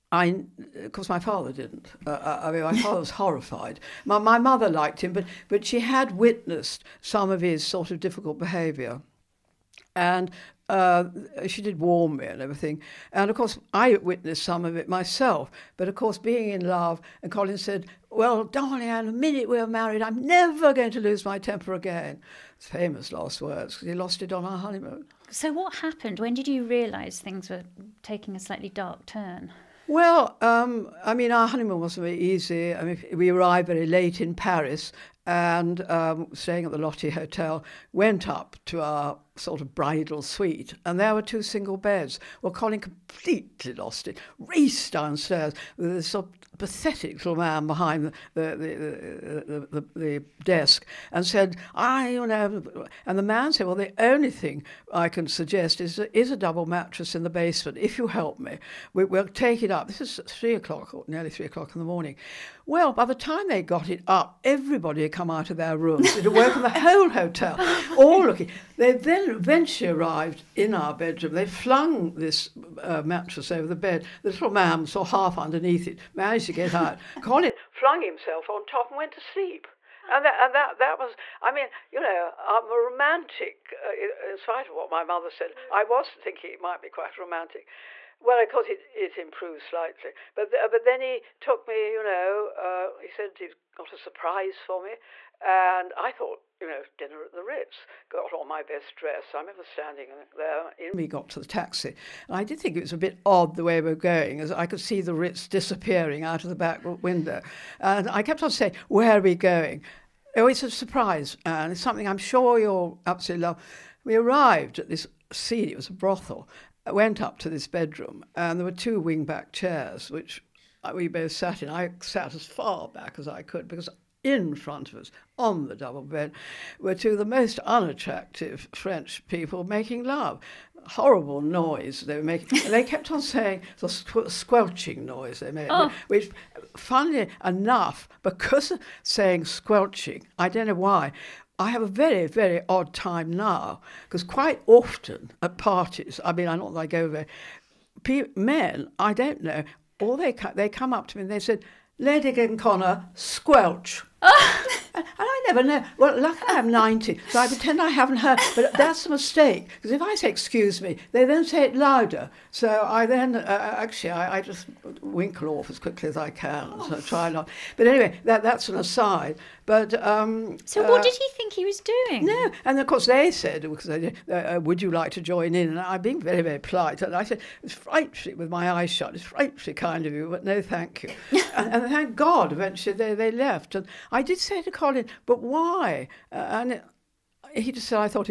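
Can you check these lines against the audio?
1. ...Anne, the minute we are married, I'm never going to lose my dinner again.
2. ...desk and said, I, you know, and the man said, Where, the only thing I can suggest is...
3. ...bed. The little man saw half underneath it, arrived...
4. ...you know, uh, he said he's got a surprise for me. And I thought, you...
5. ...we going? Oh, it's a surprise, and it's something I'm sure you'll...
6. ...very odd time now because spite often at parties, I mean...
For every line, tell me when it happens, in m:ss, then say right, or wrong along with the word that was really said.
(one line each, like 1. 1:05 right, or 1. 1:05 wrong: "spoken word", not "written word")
1. 0:18 wrong: "temper", not "dinner"
2. 0:50 wrong: "Well", not "Where"
3. 1:13 wrong: "managed", not "arrived"
4. 1:31 right
5. 1:49 right
6. 2:22 wrong: "quite", not "spite".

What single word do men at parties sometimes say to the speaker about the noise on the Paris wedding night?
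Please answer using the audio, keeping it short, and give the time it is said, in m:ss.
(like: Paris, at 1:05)
Squelch, at 2:33.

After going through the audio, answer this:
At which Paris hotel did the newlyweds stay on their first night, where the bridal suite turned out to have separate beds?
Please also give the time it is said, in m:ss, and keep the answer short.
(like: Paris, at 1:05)
Lotti Hotel, at 0:36.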